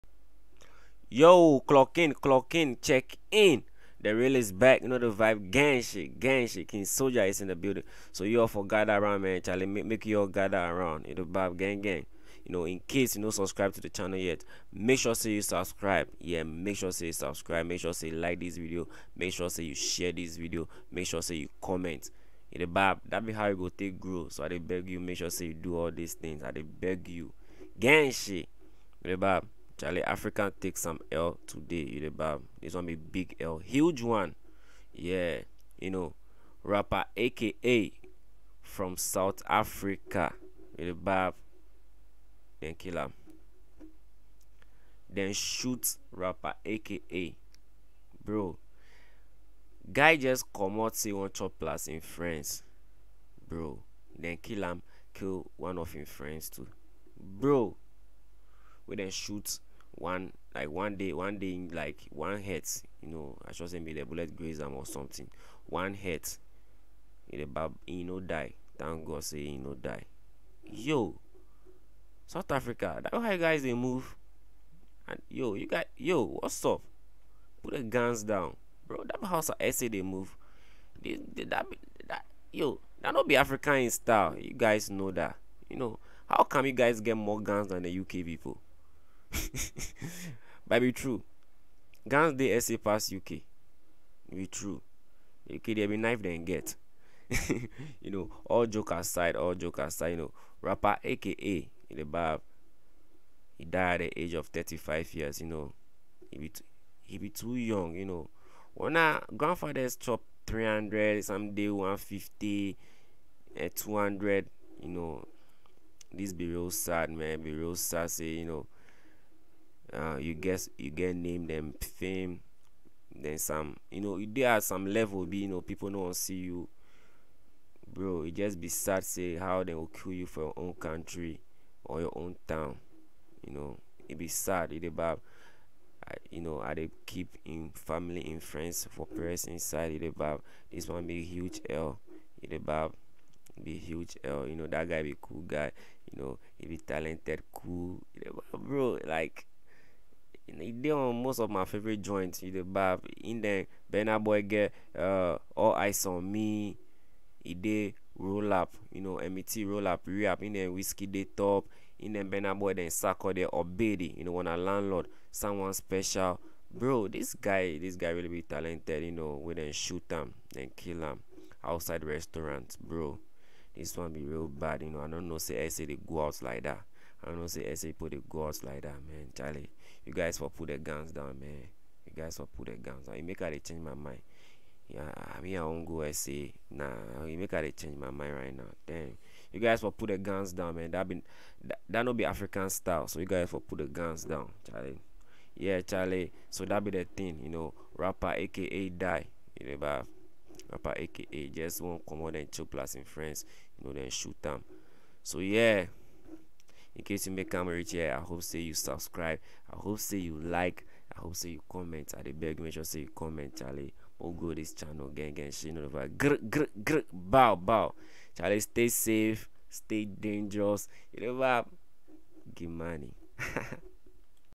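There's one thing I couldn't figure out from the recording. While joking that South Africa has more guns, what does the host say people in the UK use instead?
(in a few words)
Knife.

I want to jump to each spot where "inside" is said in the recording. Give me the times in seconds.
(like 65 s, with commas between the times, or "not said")
139 s.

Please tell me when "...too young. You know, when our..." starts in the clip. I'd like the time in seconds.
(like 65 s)
107 s.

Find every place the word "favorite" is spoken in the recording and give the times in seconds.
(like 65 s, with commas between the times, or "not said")
151 s.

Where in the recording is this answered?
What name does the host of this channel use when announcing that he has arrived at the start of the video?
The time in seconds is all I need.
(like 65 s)
6 s.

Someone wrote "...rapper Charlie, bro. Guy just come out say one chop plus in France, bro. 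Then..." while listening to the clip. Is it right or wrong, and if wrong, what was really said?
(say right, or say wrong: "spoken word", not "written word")
wrong: "AKA", not "Charlie".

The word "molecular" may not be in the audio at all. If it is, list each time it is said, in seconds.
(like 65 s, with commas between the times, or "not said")
not said.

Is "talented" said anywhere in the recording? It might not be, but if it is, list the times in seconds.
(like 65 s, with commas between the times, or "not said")
146 s, 168 s.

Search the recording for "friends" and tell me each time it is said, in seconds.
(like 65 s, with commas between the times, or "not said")
56 s, 138 s, 203 s.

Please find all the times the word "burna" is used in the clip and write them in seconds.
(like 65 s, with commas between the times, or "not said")
153 s, 162 s.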